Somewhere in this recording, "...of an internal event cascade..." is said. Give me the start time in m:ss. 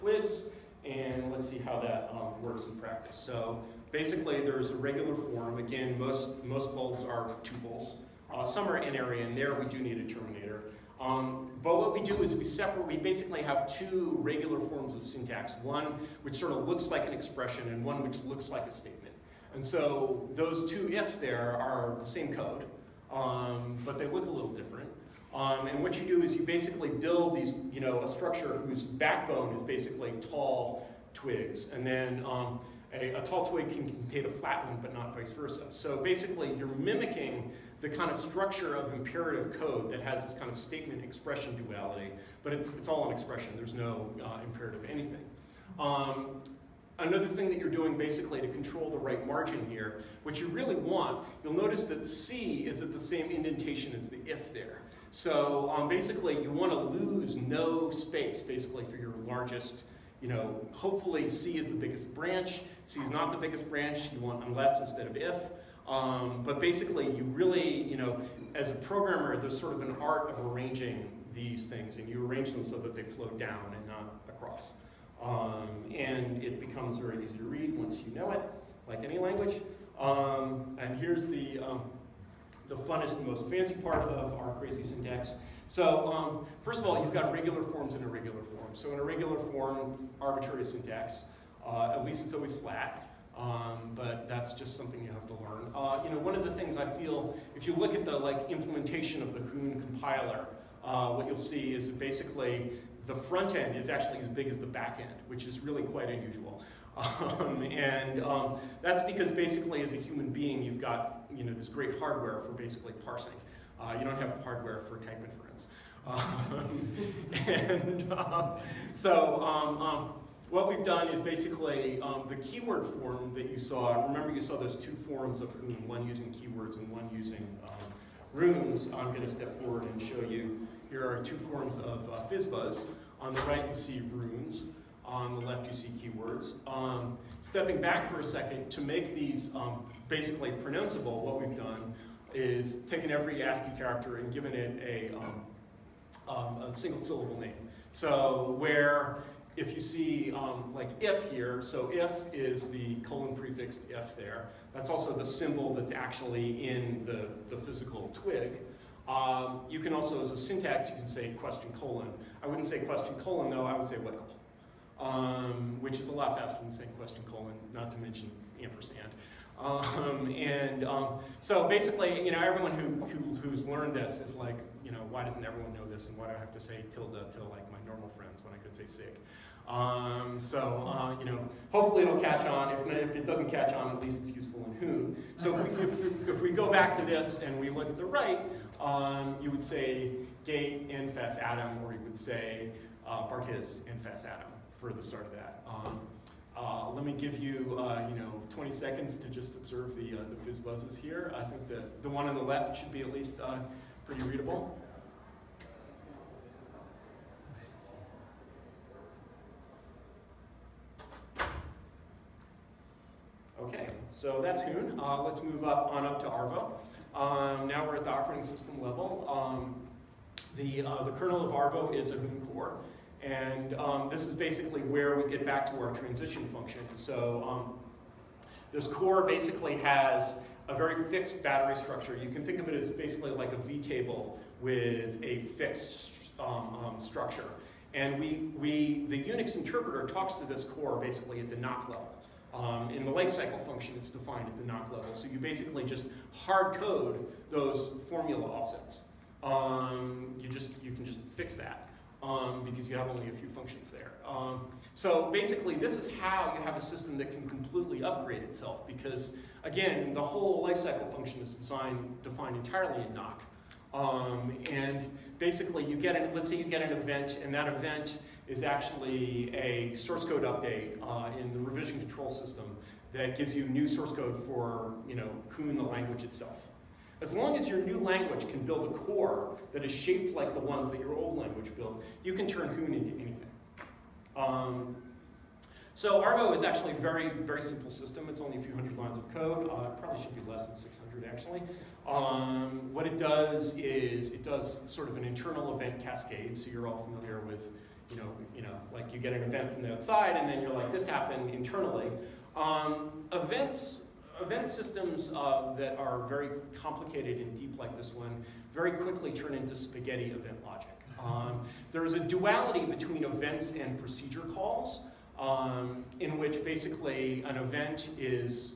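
4:55.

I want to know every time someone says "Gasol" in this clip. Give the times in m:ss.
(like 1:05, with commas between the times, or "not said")
not said.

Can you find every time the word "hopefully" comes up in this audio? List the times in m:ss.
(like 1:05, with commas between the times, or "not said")
1:00, 3:01.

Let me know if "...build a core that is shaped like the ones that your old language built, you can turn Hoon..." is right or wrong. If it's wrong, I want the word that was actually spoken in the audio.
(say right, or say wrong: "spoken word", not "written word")
right.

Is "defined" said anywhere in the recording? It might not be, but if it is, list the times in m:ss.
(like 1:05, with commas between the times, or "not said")
4:04, 4:22.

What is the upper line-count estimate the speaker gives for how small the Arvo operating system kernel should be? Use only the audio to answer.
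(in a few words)
600.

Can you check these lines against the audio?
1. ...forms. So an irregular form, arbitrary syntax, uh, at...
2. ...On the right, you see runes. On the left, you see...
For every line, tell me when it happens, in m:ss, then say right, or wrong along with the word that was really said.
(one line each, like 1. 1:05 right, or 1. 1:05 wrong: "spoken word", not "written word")
1. 1:28 right
2. 2:13 right.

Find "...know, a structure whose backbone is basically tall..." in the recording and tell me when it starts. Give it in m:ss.
0:27.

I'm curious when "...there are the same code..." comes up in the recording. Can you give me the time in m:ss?
0:21.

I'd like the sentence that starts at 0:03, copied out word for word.
So basically there's a regular form.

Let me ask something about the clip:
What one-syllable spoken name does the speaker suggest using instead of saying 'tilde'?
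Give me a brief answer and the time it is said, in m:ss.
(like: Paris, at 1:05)
sick, at 2:58.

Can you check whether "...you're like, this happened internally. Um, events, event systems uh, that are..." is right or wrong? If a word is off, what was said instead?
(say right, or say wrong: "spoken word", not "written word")
right.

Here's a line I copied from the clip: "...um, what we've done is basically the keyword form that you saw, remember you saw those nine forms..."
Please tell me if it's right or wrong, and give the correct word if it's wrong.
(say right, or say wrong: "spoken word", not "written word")
wrong: "two", not "nine".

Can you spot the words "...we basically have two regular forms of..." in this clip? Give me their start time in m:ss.
0:12.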